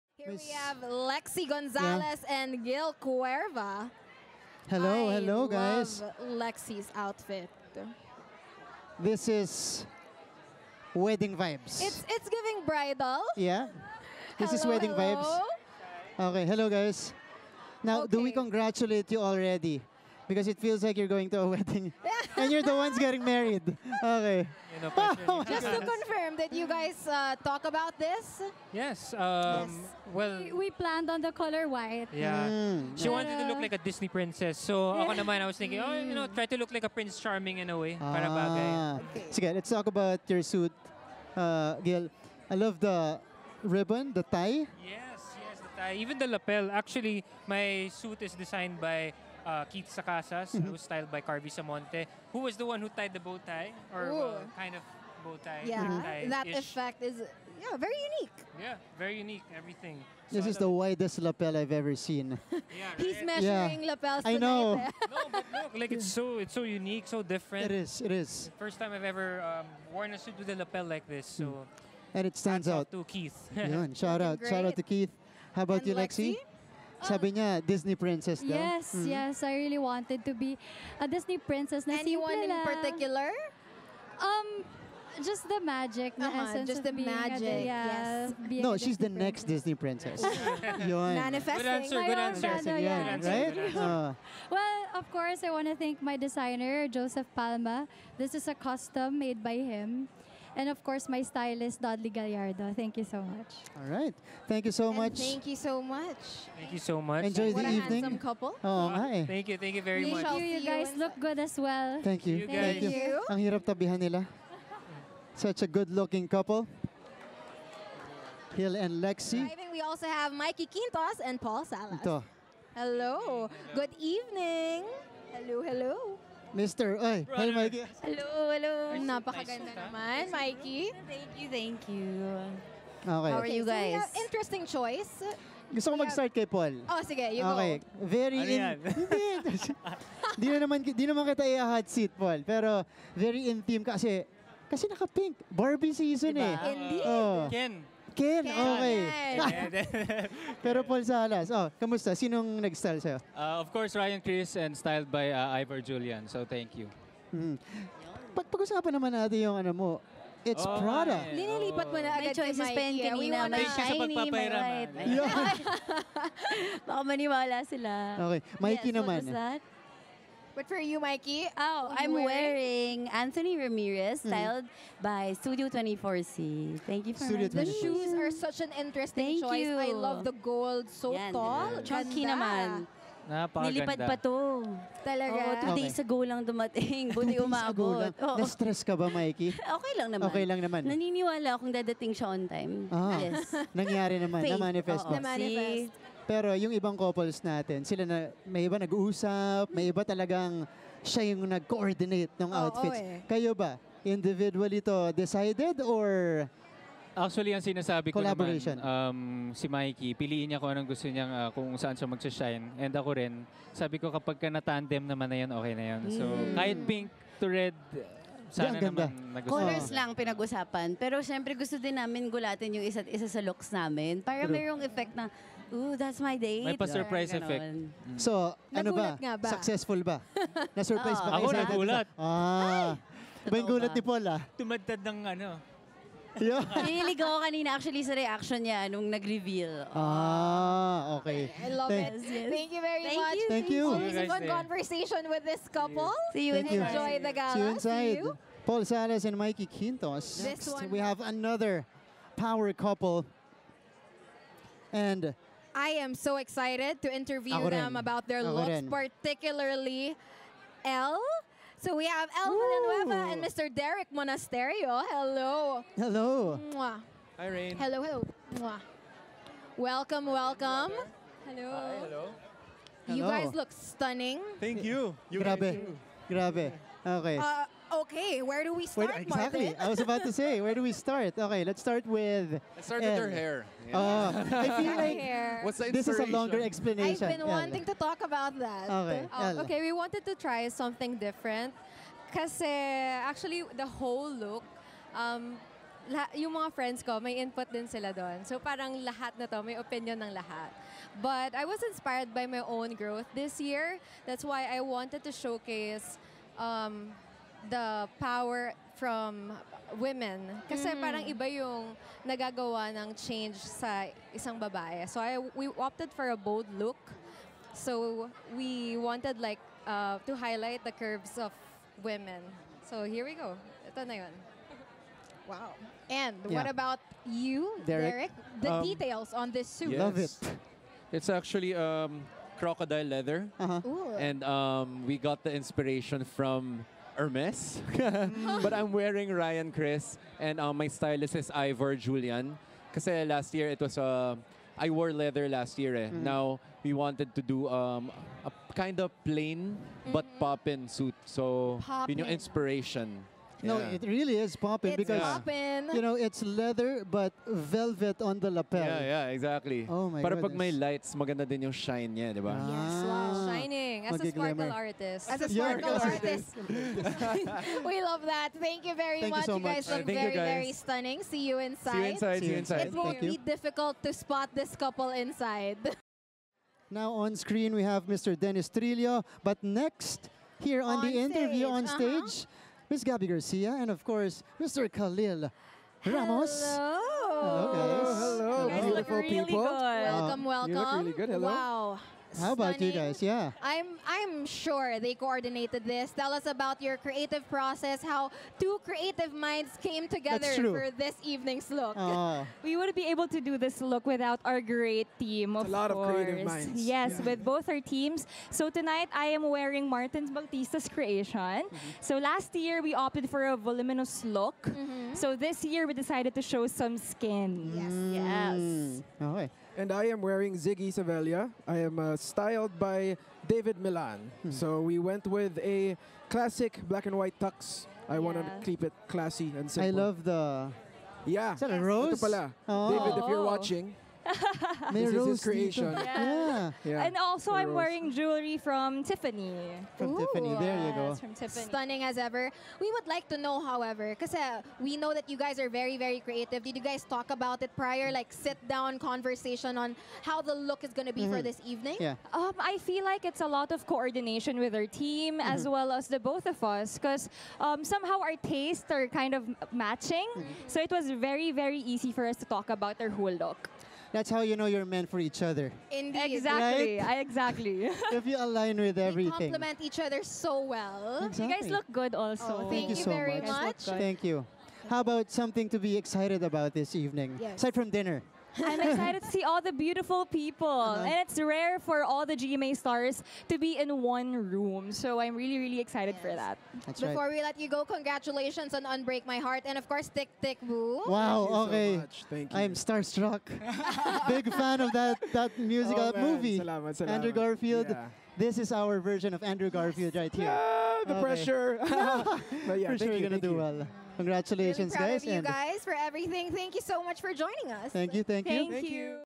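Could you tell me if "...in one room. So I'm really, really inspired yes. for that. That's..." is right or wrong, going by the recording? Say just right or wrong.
wrong.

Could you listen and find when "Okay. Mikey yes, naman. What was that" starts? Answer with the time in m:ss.
2:48.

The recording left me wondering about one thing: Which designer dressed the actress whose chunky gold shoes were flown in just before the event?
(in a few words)
Anthony Ramirez.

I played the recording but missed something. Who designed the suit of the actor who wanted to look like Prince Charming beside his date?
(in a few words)
Keith Sacasas.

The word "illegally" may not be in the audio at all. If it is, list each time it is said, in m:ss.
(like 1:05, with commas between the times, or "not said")
not said.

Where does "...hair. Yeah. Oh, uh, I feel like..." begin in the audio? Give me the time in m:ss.
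4:43.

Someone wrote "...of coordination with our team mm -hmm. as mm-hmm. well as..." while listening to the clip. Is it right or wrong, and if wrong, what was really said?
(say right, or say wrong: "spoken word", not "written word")
right.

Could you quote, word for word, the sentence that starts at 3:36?
kahit pink to red, sana Hindi, ganda.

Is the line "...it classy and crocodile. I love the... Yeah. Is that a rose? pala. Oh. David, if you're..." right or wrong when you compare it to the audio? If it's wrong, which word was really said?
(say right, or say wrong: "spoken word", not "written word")
wrong: "simple", not "crocodile".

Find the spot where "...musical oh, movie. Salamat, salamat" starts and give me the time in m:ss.
8:15.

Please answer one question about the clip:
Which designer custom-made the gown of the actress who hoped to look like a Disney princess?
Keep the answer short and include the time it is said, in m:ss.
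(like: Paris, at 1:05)
Joseph Palma, at 1:36.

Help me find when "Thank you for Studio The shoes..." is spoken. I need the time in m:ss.
2:56.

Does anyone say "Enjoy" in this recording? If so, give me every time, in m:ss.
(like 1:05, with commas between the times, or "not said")
1:47, 4:07.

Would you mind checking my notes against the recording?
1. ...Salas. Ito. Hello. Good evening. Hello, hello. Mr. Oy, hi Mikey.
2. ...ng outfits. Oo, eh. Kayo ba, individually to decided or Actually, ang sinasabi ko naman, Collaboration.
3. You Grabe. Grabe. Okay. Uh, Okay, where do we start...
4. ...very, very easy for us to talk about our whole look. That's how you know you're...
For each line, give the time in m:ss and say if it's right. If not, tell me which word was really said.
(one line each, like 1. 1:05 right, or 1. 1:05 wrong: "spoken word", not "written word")
1. 2:01 right
2. 3:22 right
3. 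4:35 right
4. 7:41 right.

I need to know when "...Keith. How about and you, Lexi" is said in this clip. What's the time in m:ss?
1:14.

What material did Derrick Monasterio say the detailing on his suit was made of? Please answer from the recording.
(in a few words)
crocodile leather.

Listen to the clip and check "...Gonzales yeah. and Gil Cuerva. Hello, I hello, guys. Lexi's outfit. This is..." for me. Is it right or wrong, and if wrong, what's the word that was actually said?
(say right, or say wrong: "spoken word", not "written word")
right.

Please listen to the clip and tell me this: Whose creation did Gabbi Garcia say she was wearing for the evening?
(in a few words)
Martins Bautista.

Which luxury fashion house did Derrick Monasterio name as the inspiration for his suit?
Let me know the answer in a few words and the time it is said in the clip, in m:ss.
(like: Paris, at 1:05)
Hermes, at 5:37.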